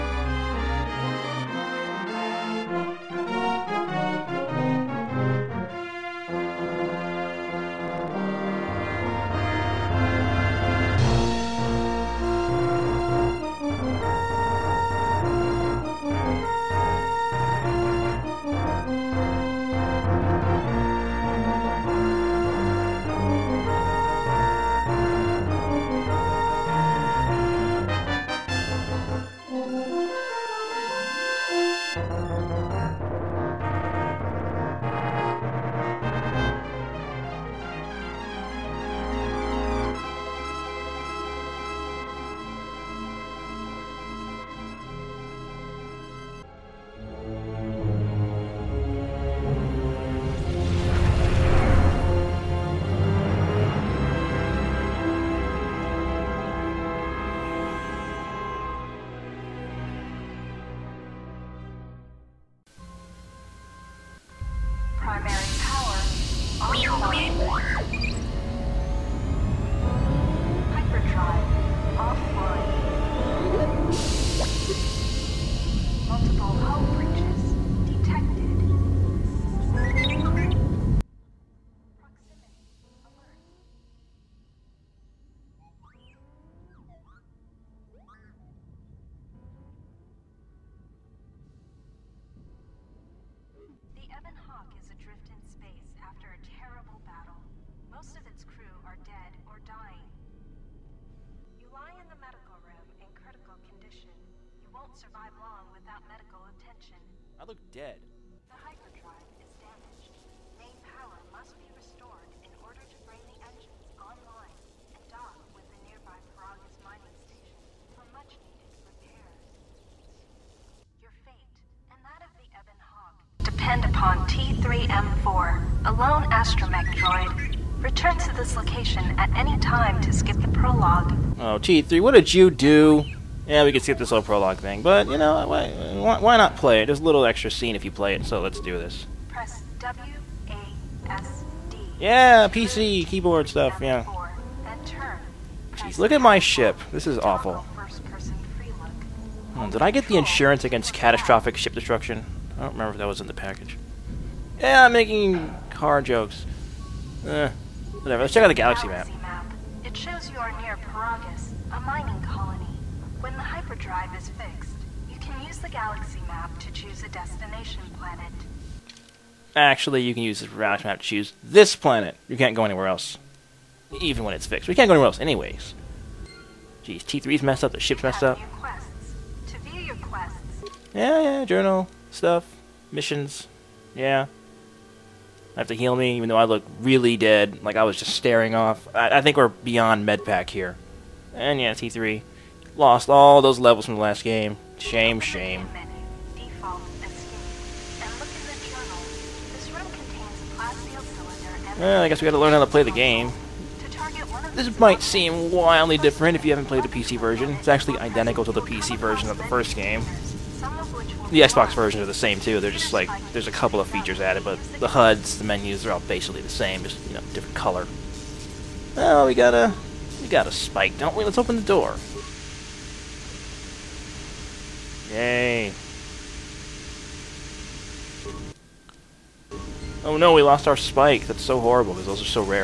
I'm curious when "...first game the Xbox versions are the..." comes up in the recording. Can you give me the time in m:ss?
3:29.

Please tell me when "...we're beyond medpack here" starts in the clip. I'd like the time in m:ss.
3:09.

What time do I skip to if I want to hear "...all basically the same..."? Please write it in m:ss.
3:35.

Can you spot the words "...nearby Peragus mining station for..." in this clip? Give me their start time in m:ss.
1:55.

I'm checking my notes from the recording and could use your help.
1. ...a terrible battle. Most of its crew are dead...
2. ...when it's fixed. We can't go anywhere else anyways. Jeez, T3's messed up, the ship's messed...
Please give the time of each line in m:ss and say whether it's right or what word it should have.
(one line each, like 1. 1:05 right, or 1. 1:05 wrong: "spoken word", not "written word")
1. 1:36 right
2. 2:54 right.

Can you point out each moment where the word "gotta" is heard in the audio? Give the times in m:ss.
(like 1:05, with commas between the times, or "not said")
3:22.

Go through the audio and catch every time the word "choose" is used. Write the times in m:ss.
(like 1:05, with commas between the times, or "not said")
2:46, 2:51.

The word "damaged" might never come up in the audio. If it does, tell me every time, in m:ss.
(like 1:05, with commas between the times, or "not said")
1:49.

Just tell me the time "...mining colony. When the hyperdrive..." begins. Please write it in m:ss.
2:41.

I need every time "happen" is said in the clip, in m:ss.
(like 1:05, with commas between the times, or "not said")
not said.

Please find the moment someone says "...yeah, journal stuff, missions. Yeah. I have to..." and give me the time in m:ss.
3:01.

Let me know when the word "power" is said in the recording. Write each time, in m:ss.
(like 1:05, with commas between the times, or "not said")
1:05, 1:50.